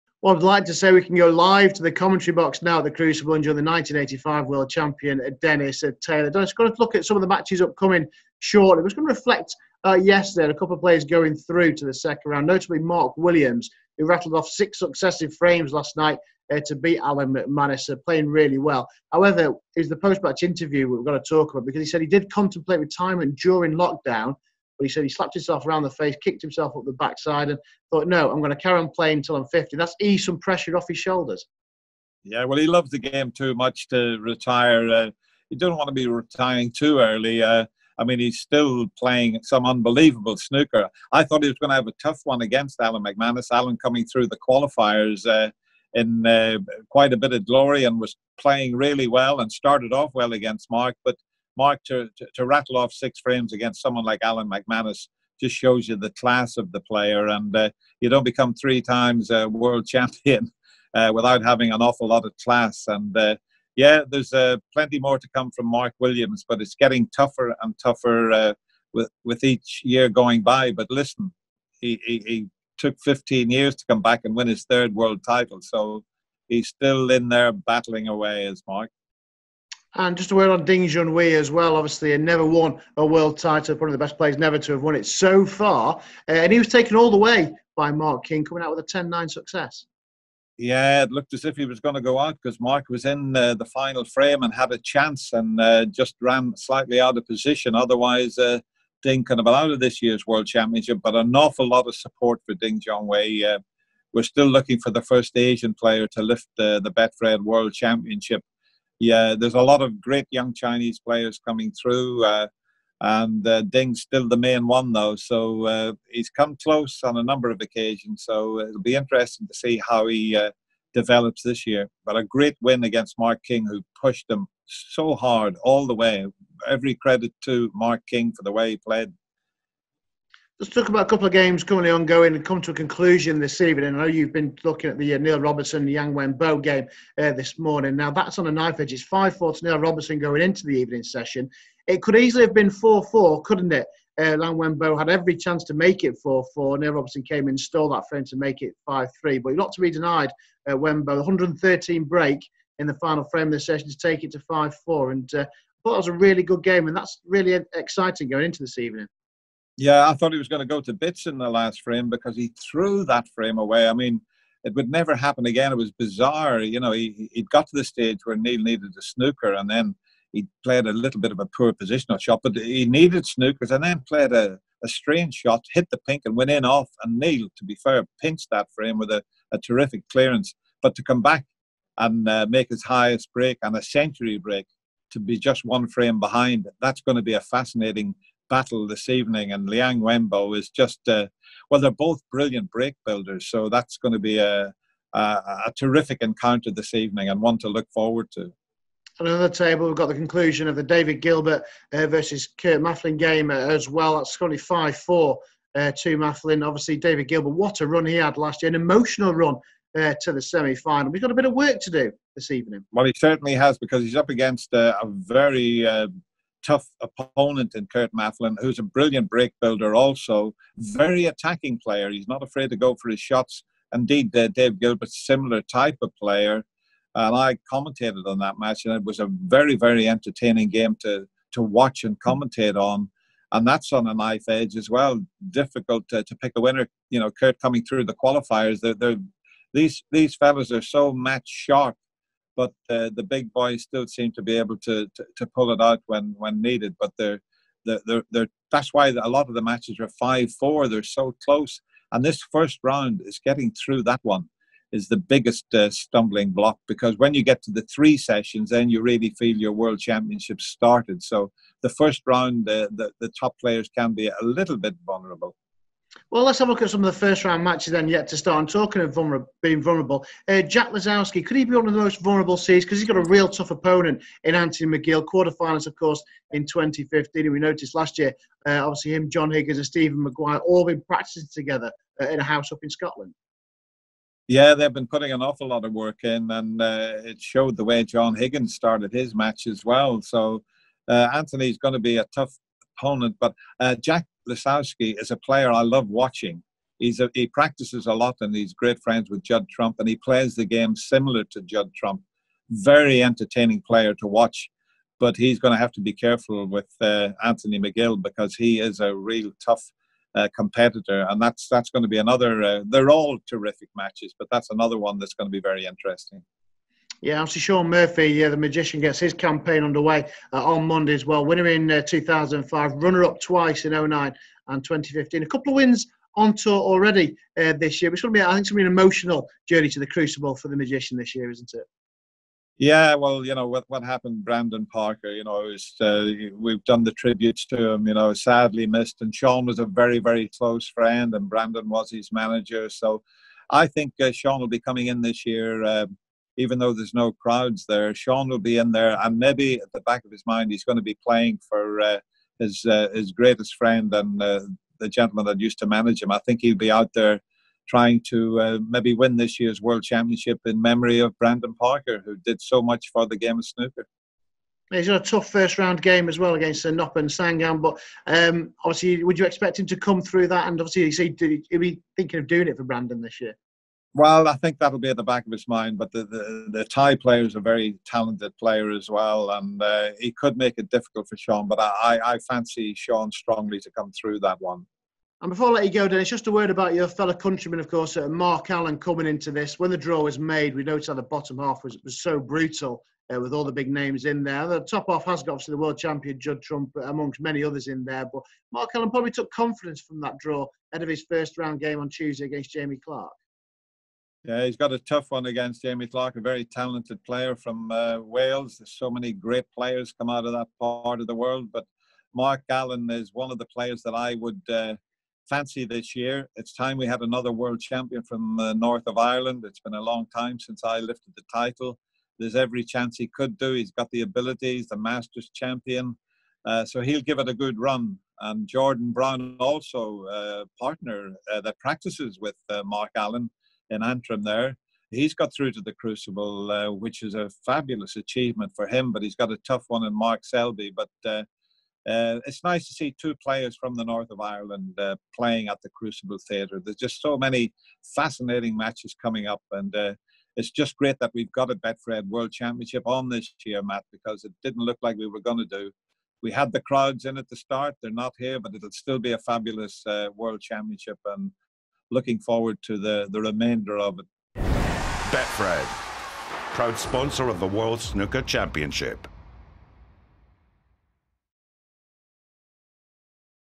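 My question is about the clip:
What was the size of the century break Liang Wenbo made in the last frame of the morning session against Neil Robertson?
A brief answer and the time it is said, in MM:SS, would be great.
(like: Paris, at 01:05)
113, at 02:31.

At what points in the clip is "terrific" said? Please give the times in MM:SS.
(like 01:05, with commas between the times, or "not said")
02:59, 03:15, 05:13.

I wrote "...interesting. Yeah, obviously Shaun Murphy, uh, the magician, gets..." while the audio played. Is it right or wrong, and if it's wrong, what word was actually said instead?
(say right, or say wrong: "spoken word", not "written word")
right.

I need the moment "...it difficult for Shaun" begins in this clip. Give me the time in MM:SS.
06:20.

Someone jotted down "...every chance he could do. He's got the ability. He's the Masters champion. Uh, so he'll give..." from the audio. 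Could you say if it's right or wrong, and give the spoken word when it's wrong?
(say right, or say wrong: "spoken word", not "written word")
right.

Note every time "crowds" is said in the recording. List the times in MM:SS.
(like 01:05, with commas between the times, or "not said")
05:47, 07:36.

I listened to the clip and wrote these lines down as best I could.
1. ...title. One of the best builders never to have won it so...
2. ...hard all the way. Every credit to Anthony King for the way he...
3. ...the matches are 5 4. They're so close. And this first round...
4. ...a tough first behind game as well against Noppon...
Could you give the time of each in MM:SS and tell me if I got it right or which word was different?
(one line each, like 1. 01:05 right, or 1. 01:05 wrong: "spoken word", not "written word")
1. 01:23 wrong: "players", not "builders"
2. 02:05 wrong: "Mark", not "Anthony"
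3. 04:09 right
4. 06:05 wrong: "round", not "behind".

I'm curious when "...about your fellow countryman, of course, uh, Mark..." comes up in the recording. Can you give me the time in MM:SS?
06:26.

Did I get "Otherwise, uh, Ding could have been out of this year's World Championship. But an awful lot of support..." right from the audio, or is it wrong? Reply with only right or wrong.
right.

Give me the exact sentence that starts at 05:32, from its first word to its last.
Yeah, well, you know what what happened, Brandon Parker.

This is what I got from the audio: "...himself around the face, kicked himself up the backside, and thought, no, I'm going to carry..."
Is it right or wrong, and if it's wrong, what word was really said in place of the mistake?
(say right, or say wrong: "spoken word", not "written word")
right.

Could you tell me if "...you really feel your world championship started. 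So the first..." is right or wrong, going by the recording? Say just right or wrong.
right.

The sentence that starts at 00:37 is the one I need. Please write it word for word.
Uh, I mean, he's still playing some unbelievable snooker.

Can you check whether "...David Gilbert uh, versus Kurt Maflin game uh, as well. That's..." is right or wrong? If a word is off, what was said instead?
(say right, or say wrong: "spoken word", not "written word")
right.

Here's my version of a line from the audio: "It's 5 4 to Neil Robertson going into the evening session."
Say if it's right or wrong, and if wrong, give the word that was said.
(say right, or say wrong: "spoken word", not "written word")
right.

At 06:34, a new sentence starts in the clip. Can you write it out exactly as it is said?
The top half has got obviously the world champion Judd Trump, uh, amongst many others in there.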